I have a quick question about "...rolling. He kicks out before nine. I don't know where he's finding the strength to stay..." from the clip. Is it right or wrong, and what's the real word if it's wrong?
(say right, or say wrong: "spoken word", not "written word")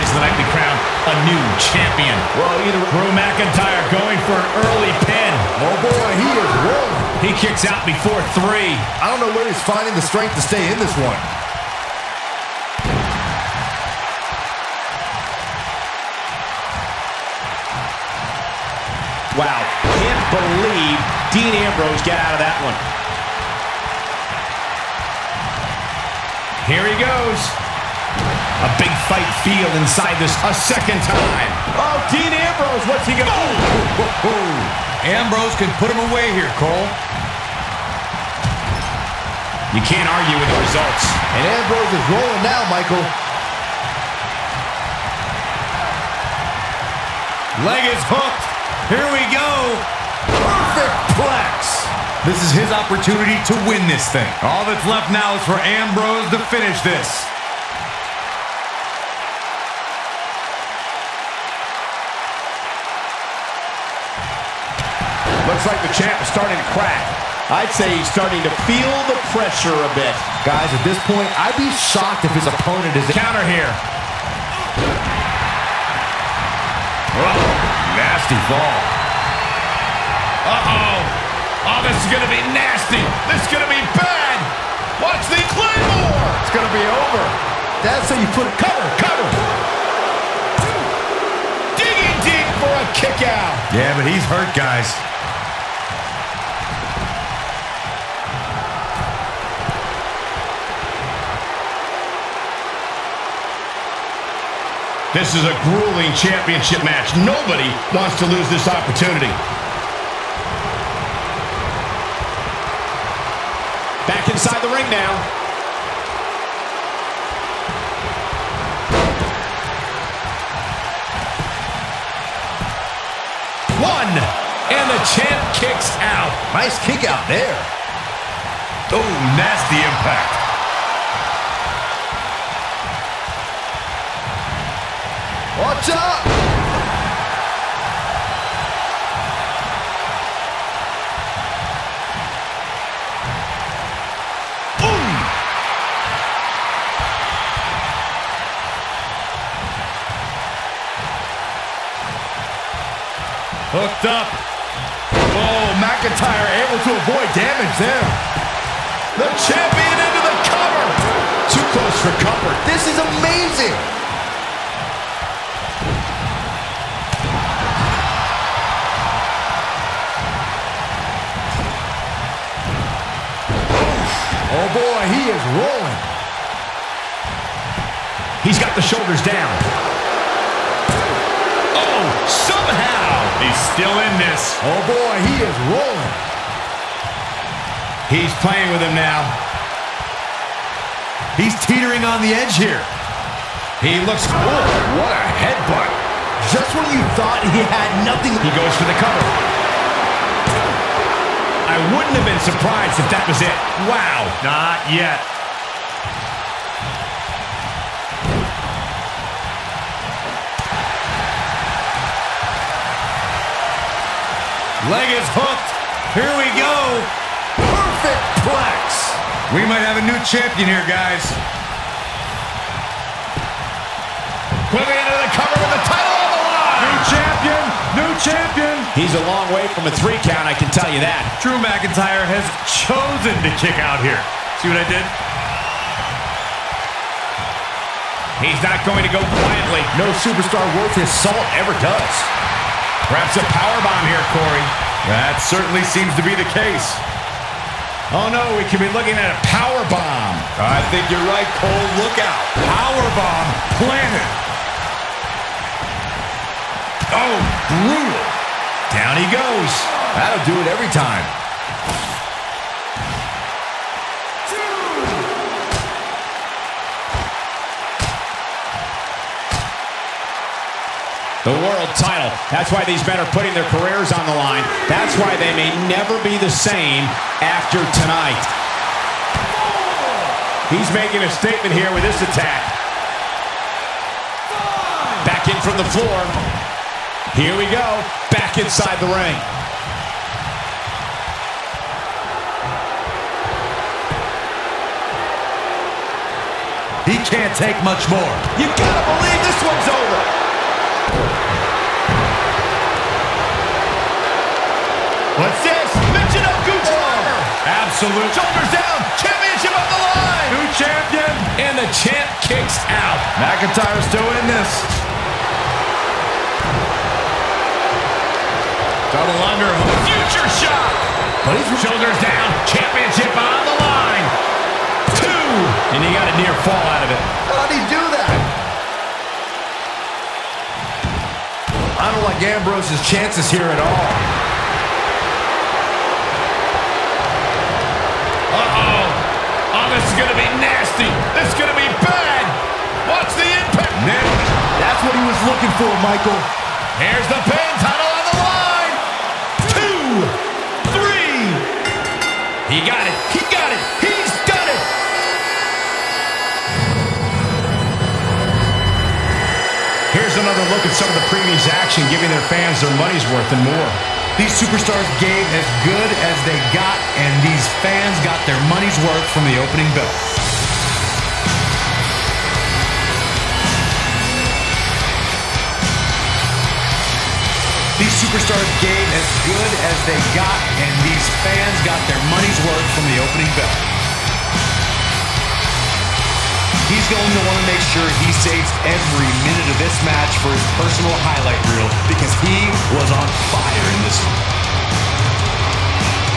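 wrong: "three", not "nine".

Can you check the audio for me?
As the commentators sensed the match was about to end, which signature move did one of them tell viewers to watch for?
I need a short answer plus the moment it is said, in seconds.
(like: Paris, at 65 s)
Claymore, at 85 s.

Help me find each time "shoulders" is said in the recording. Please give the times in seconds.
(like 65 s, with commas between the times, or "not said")
178 s, 308 s, 321 s.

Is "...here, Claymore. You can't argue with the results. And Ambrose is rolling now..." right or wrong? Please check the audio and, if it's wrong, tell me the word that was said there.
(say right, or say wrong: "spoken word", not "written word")
wrong: "Cole", not "Claymore".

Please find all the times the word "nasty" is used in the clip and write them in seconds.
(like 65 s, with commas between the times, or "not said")
77 s, 82 s, 129 s.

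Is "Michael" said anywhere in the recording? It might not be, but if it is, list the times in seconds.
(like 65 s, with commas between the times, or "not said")
42 s, 346 s.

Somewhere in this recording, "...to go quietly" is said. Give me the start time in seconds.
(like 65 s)
239 s.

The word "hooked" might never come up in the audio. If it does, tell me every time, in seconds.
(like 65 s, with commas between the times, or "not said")
48 s, 215 s.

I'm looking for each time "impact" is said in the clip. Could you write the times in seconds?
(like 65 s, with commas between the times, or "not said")
129 s, 343 s.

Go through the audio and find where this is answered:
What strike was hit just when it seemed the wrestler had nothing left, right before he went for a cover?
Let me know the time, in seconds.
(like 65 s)
195 s.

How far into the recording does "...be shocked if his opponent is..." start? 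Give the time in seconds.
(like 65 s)
71 s.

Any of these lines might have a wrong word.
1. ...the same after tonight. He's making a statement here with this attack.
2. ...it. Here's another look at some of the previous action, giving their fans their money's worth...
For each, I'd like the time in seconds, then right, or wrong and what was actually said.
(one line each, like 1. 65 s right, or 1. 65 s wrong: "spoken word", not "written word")
1. 276 s right
2. 354 s right.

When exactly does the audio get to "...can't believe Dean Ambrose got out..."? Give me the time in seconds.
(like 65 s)
19 s.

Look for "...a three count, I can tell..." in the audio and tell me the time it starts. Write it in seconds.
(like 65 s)
229 s.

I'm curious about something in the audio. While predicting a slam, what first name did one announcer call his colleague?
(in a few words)
Corey.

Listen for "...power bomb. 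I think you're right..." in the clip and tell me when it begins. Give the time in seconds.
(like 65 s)
249 s.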